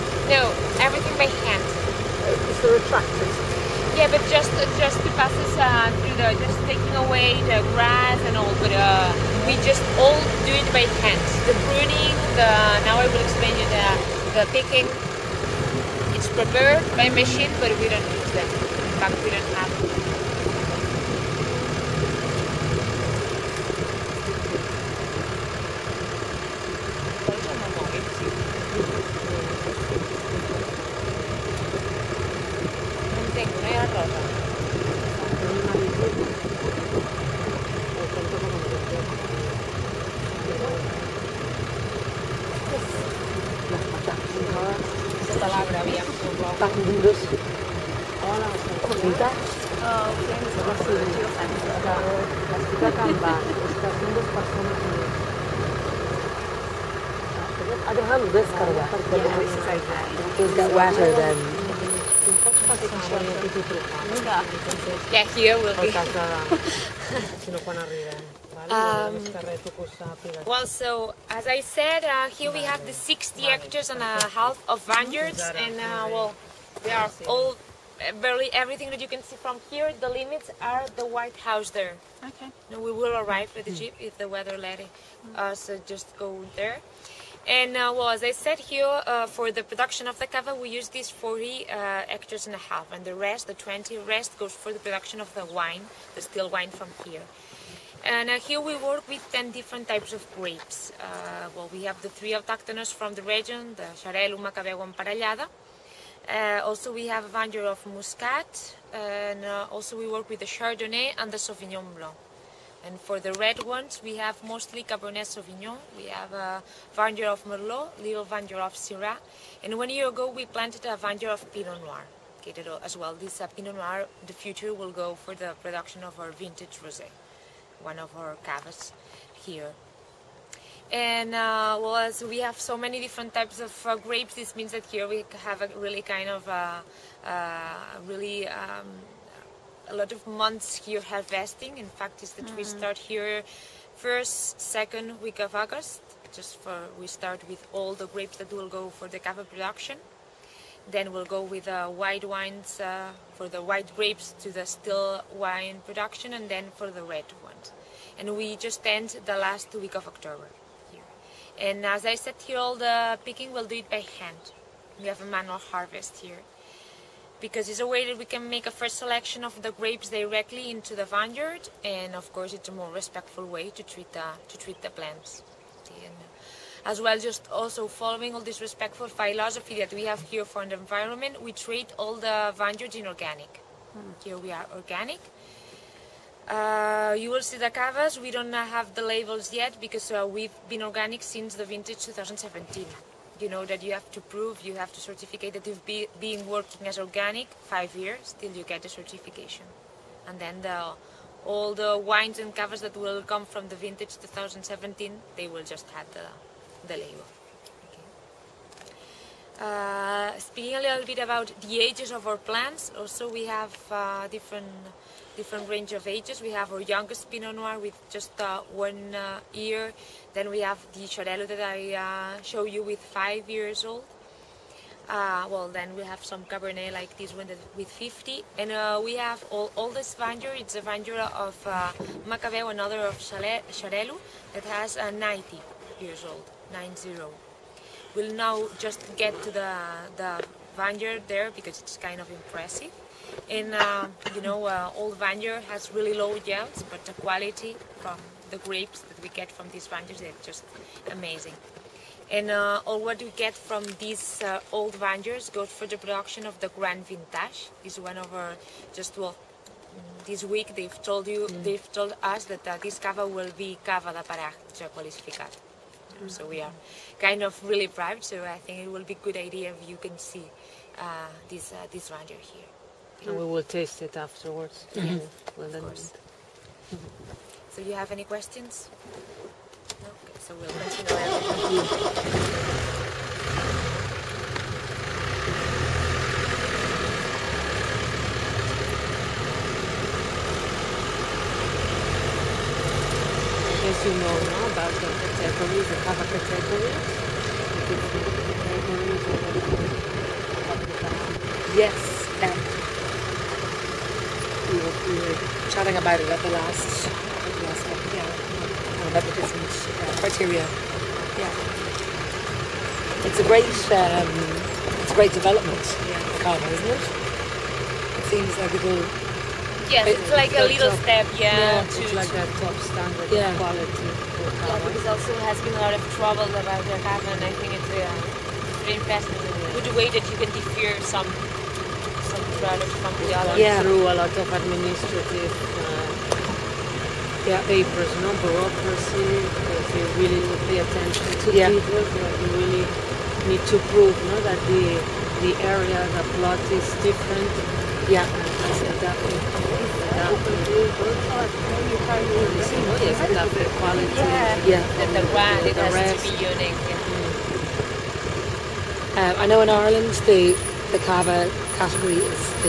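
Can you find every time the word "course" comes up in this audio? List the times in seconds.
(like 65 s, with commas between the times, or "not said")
172 s, 275 s.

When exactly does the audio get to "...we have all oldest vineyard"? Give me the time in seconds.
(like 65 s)
229 s.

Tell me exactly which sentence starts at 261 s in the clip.
they've told us that uh, this cava will be cava de paraje calificado.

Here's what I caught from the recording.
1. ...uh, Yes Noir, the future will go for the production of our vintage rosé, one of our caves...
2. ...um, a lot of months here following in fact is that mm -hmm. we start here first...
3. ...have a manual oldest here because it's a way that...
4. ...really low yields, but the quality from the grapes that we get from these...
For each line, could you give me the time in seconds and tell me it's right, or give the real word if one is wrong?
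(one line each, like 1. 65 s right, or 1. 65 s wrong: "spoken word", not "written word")
1. 123 s wrong: "Pinot", not "Yes"
2. 138 s wrong: "harvesting", not "following"
3. 165 s wrong: "harvest", not "oldest"
4. 245 s right.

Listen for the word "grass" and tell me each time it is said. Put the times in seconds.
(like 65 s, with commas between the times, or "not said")
7 s.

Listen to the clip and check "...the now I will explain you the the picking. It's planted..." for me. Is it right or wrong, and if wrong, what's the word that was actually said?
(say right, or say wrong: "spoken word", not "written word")
wrong: "prepared", not "planted".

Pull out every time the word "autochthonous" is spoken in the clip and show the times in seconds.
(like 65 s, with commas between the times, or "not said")
102 s.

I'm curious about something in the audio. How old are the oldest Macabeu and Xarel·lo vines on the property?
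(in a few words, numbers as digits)
90 years.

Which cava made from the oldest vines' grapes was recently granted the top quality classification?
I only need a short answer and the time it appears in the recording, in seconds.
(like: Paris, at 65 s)
Grand Vintage, at 256 s.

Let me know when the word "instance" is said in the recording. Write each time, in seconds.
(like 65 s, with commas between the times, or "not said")
not said.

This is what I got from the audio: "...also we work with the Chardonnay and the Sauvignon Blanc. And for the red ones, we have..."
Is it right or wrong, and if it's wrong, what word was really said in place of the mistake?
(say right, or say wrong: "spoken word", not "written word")
right.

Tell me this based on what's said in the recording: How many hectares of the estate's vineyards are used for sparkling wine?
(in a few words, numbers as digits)
40 and a half.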